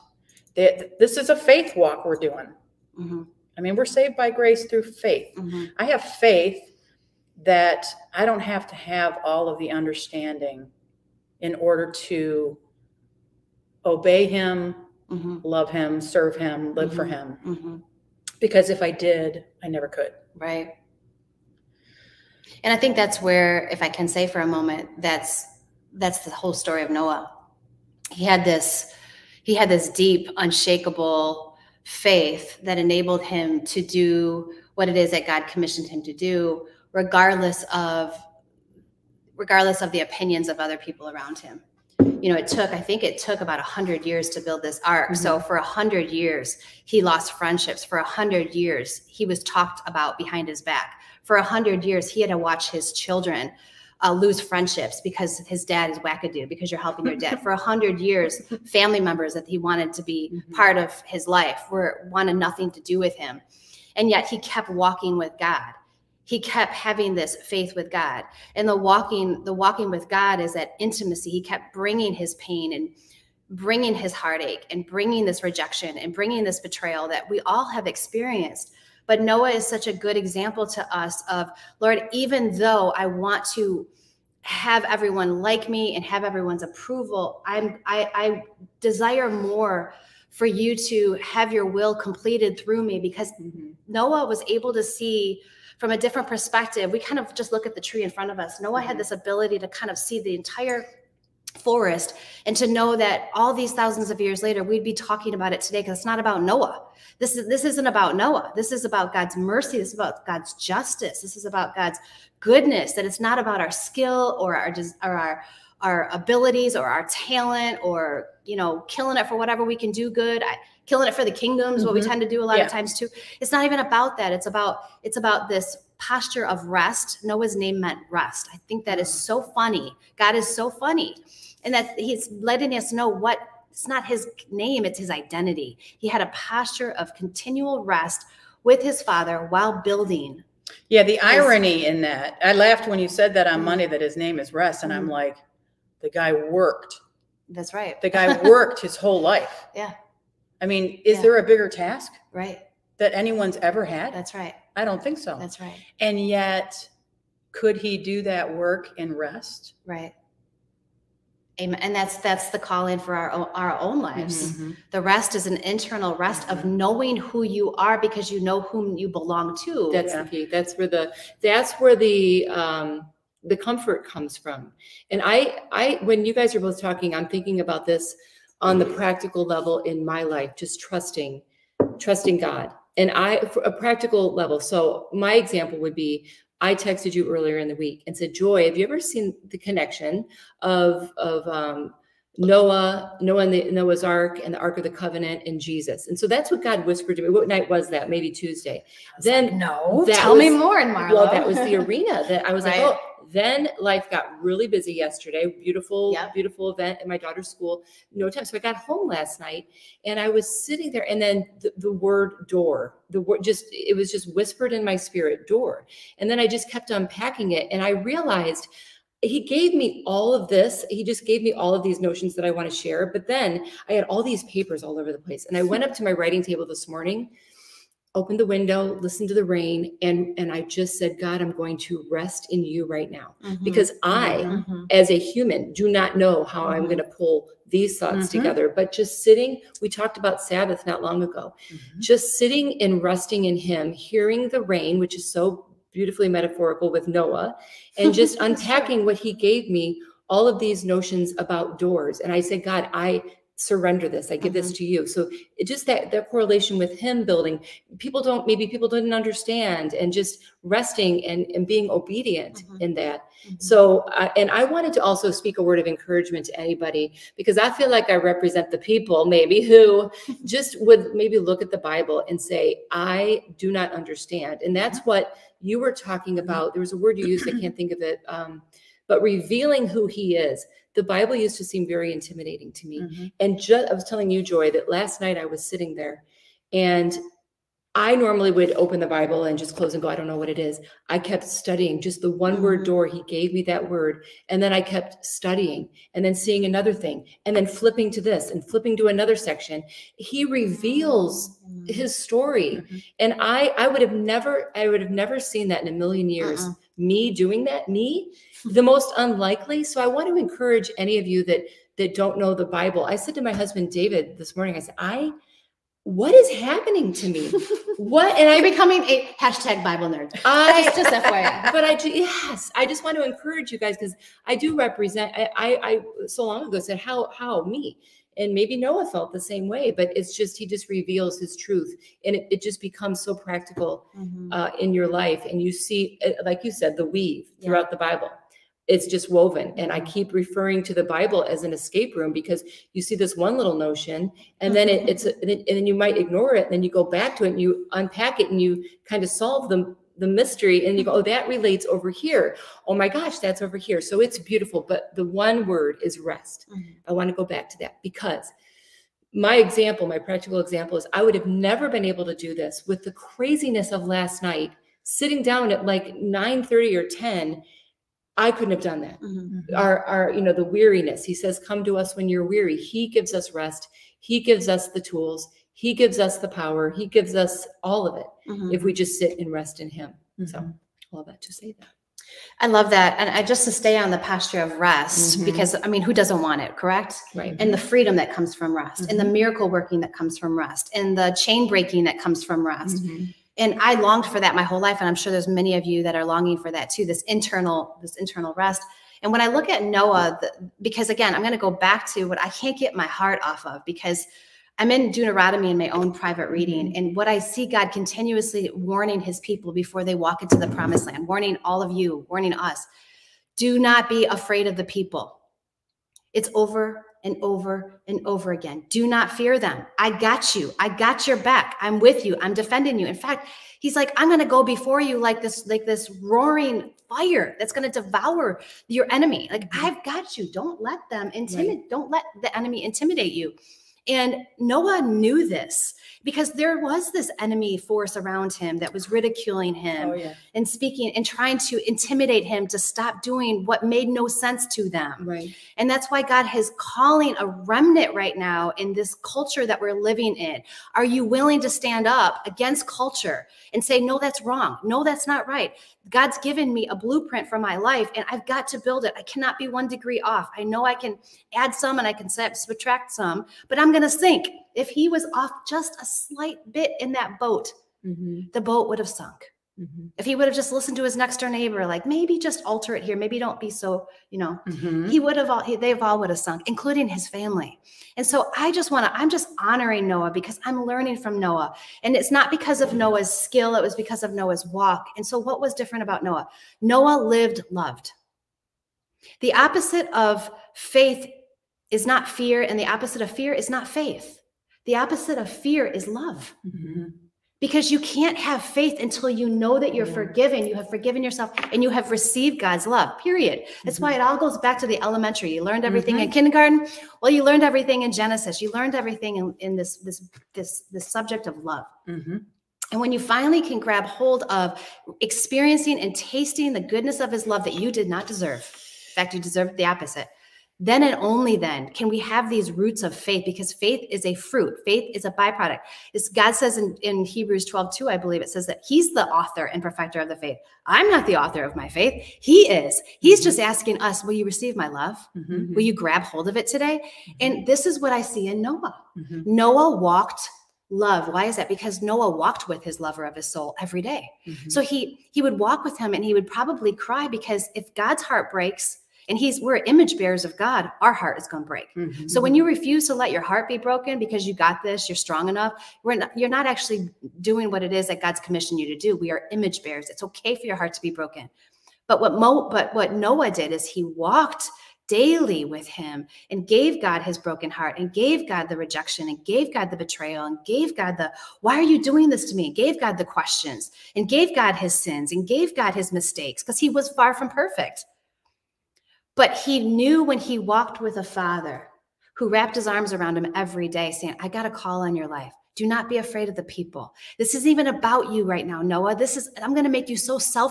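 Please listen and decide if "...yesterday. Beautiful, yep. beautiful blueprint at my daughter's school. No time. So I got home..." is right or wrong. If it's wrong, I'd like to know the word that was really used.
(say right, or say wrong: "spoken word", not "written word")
wrong: "event", not "blueprint".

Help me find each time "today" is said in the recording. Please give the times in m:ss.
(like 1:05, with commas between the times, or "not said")
1:45, 8:56.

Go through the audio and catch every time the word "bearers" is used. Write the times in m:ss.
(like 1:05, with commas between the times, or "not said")
9:10, 9:19.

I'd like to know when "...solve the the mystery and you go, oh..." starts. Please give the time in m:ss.
5:49.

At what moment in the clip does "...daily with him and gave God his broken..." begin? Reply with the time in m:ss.
9:25.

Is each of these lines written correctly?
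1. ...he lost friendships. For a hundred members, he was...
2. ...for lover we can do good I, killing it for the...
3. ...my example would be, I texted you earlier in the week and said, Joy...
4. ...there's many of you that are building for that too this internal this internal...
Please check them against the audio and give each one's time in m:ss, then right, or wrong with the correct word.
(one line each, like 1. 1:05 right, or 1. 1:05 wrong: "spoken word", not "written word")
1. 0:46 wrong: "years", not "members"
2. 1:59 wrong: "whatever", not "lover"
3. 3:05 right
4. 6:35 wrong: "longing", not "building".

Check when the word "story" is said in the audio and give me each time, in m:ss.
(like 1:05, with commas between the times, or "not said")
0:26, 5:02.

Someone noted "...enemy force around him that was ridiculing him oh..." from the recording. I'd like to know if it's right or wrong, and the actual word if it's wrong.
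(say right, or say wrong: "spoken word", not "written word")
right.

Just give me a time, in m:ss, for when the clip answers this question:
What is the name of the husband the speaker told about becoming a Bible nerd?
5:13.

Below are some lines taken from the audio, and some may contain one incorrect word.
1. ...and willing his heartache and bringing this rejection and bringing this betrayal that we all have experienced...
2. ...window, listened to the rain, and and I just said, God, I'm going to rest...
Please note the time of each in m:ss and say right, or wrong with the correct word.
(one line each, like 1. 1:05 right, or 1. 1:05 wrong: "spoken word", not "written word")
1. 1:12 wrong: "bringing", not "willing"
2. 3:48 right.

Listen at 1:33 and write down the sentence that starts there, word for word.
Noah was able to see from a different perspective.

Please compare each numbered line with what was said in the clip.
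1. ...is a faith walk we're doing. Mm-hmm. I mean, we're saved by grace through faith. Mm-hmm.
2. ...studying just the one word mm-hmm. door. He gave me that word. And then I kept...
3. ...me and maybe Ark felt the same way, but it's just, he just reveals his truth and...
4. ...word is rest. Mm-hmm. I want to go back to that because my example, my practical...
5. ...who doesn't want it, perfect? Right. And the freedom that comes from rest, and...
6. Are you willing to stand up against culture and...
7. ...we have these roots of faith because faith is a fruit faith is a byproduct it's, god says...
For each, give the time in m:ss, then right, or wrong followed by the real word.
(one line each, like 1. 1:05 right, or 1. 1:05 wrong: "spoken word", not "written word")
1. 0:01 right
2. 4:51 right
3. 5:27 wrong: "Noah", not "Ark"
4. 5:55 right
5. 6:26 wrong: "correct", not "perfect"
6. 7:30 right
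7. 8:42 right.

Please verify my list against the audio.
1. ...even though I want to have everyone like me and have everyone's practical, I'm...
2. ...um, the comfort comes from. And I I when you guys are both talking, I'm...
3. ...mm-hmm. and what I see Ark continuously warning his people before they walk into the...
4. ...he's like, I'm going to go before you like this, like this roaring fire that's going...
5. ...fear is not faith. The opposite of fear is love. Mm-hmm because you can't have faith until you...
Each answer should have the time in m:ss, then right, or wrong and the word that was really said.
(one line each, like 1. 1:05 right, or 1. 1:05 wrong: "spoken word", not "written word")
1. 1:22 wrong: "approval", not "practical"
2. 2:52 right
3. 6:46 wrong: "God", not "Ark"
4. 7:03 right
5. 8:13 right.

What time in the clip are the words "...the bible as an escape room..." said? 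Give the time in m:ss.
5:40.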